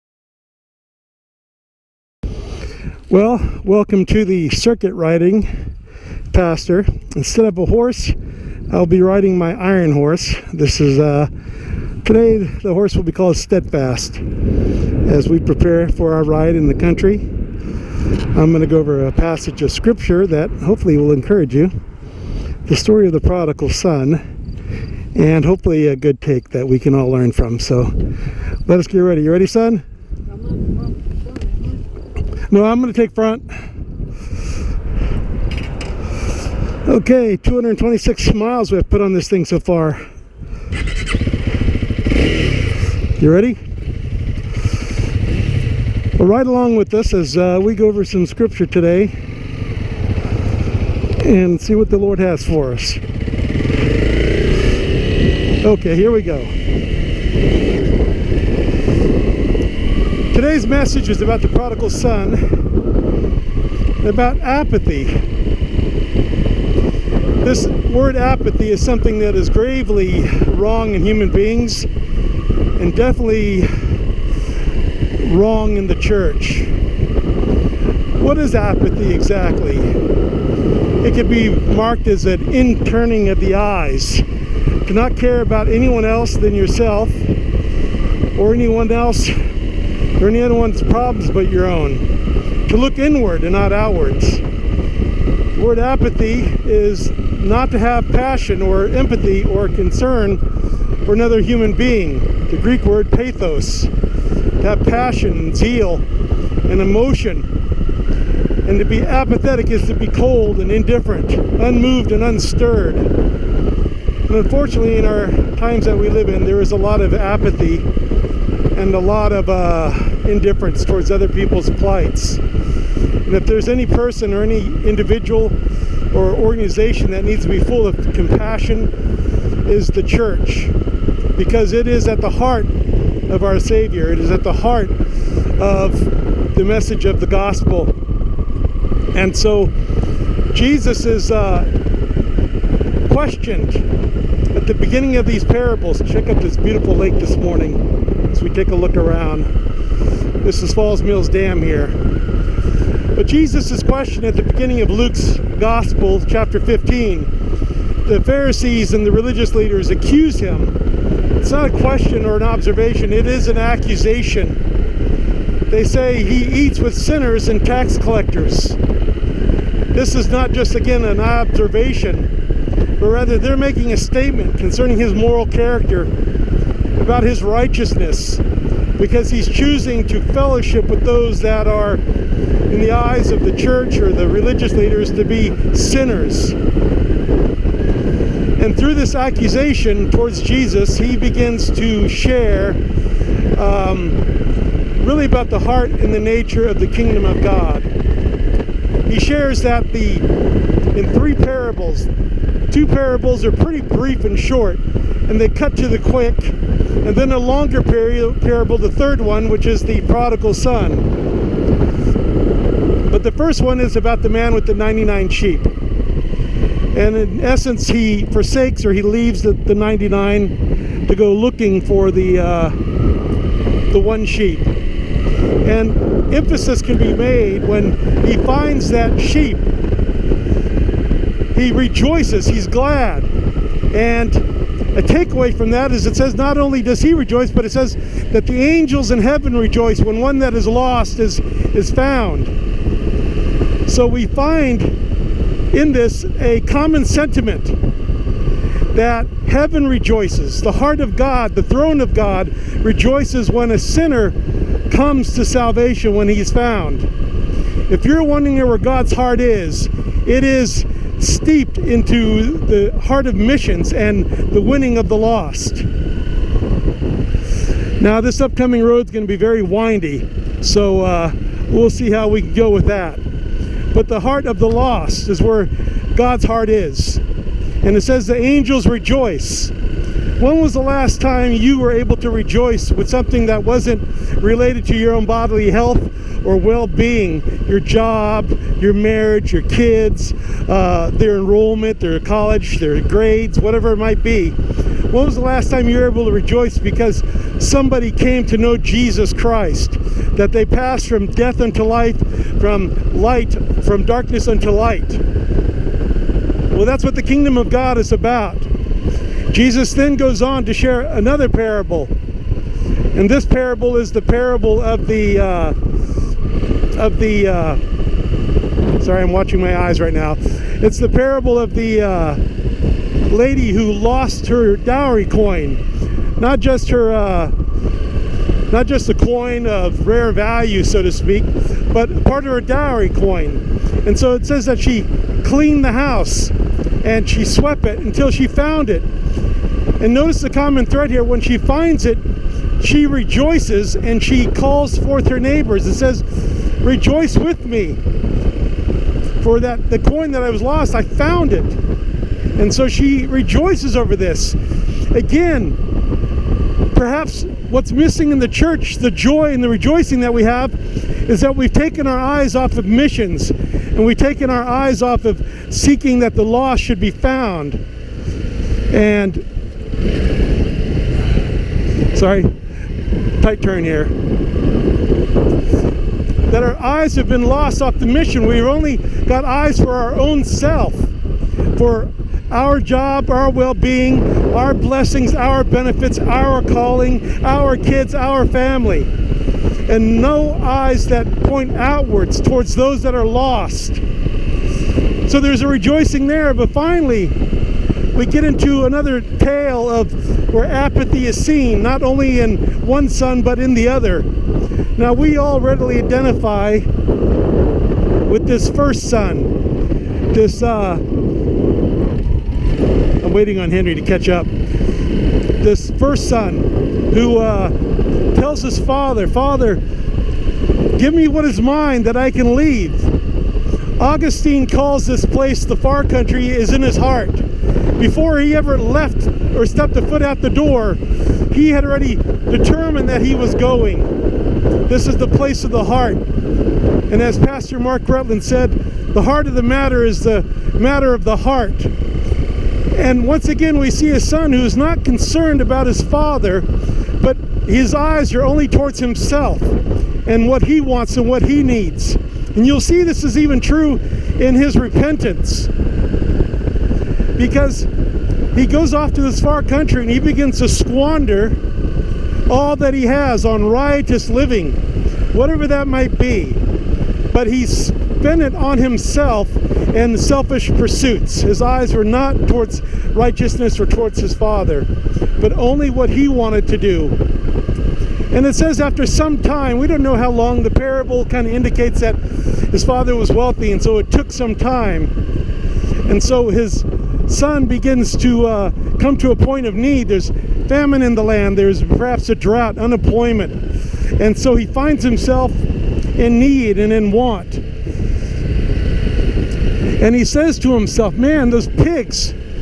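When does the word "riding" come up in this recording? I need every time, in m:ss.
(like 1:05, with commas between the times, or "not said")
0:04, 0:09.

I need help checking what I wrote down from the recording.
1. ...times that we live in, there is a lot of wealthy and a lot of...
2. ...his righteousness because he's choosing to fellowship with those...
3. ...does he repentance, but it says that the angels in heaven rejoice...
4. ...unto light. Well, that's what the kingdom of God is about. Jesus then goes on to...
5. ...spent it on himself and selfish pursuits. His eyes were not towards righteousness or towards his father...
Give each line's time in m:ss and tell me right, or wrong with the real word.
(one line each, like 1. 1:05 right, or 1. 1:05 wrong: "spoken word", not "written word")
1. 1:55 wrong: "apathy", not "wealthy"
2. 2:57 right
3. 3:56 wrong: "rejoice", not "repentance"
4. 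5:04 right
5. 7:47 right.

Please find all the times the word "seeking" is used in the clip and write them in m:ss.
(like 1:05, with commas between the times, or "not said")
6:05.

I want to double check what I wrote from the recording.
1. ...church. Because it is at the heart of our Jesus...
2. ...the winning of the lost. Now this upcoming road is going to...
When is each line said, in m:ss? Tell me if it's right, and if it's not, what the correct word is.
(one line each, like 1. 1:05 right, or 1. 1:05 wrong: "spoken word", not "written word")
1. 2:10 wrong: "Savior", not "Jesus"
2. 4:24 right.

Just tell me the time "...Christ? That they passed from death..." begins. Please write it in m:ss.
4:59.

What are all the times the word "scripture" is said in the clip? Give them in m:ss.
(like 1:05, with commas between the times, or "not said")
0:19, 0:48.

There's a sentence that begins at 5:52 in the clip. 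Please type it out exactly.
And so she rejoices over this.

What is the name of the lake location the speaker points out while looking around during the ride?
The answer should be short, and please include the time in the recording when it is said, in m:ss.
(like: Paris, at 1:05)
Falls Mills Dam, at 2:30.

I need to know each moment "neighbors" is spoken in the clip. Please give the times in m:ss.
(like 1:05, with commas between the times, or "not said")
5:45.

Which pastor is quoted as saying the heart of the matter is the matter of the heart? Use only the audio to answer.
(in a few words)
Mark Rutland.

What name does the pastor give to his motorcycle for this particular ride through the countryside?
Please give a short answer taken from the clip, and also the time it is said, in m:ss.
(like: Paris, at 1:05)
Steadfast, at 0:13.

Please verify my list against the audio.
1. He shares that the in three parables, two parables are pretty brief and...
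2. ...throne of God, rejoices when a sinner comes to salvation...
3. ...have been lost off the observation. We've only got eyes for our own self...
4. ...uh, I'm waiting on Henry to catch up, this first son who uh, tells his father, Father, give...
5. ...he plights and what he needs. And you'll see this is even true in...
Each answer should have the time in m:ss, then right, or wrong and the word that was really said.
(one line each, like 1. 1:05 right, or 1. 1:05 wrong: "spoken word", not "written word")
1. 3:19 right
2. 4:11 right
3. 6:17 wrong: "mission", not "observation"
4. 6:50 right
5. 7:30 wrong: "wants", not "plights".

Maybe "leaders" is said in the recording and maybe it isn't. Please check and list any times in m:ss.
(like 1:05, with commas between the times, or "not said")
2:39, 3:04.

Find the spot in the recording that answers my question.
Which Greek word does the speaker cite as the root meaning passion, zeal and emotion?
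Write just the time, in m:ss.
1:43.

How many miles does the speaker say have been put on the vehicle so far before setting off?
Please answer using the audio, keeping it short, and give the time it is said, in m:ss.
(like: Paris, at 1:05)
226, at 0:37.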